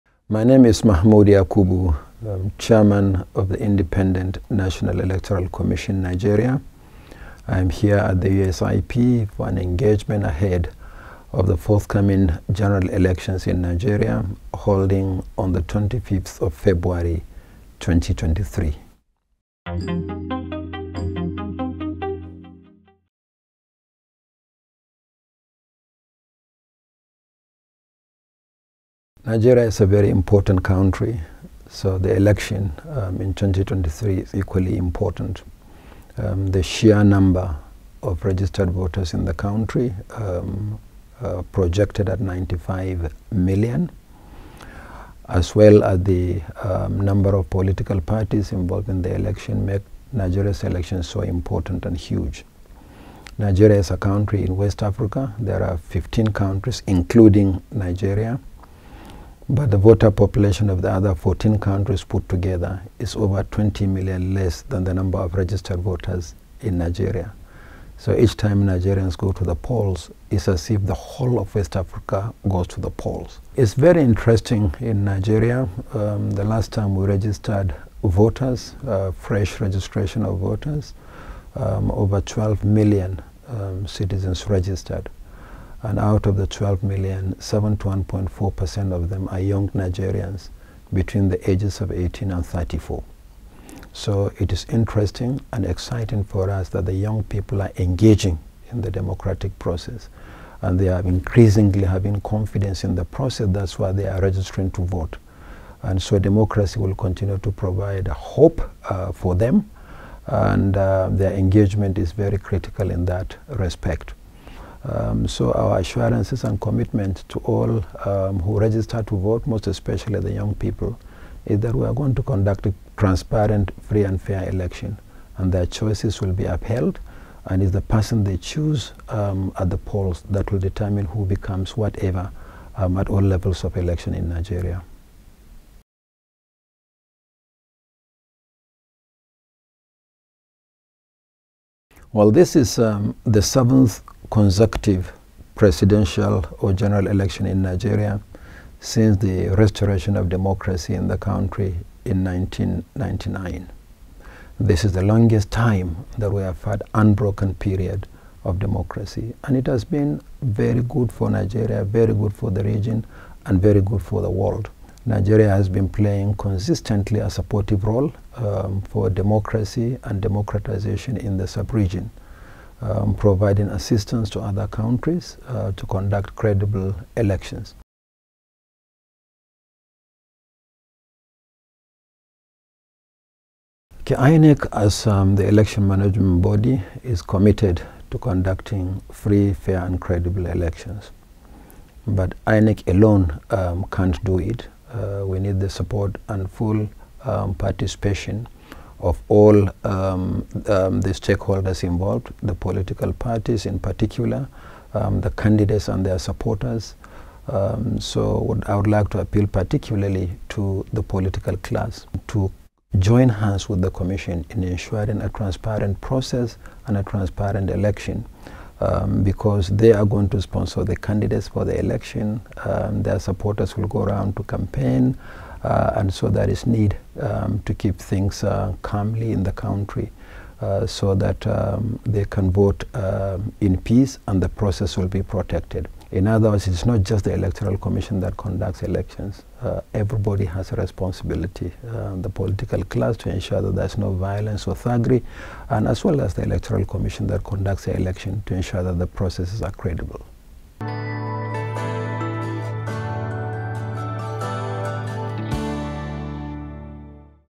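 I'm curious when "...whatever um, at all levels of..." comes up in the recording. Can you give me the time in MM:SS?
02:11.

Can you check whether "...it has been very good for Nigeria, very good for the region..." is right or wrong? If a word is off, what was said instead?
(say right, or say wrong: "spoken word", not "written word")
right.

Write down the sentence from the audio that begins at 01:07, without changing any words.
So each time Nigerians go to the polls, it's as if the whole of West Africa goes to the polls.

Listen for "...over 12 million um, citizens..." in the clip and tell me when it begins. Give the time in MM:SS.
01:21.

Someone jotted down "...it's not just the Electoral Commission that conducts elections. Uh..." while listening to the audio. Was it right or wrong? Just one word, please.
right.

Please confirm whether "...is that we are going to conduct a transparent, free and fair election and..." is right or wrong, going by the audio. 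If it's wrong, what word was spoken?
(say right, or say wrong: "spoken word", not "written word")
right.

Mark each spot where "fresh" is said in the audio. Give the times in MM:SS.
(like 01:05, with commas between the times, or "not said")
01:19.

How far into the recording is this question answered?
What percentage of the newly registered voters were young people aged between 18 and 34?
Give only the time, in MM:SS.
01:27.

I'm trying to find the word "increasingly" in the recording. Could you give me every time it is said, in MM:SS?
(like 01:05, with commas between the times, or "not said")
01:41.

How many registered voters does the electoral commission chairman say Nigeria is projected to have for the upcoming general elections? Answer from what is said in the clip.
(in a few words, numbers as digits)
95 million.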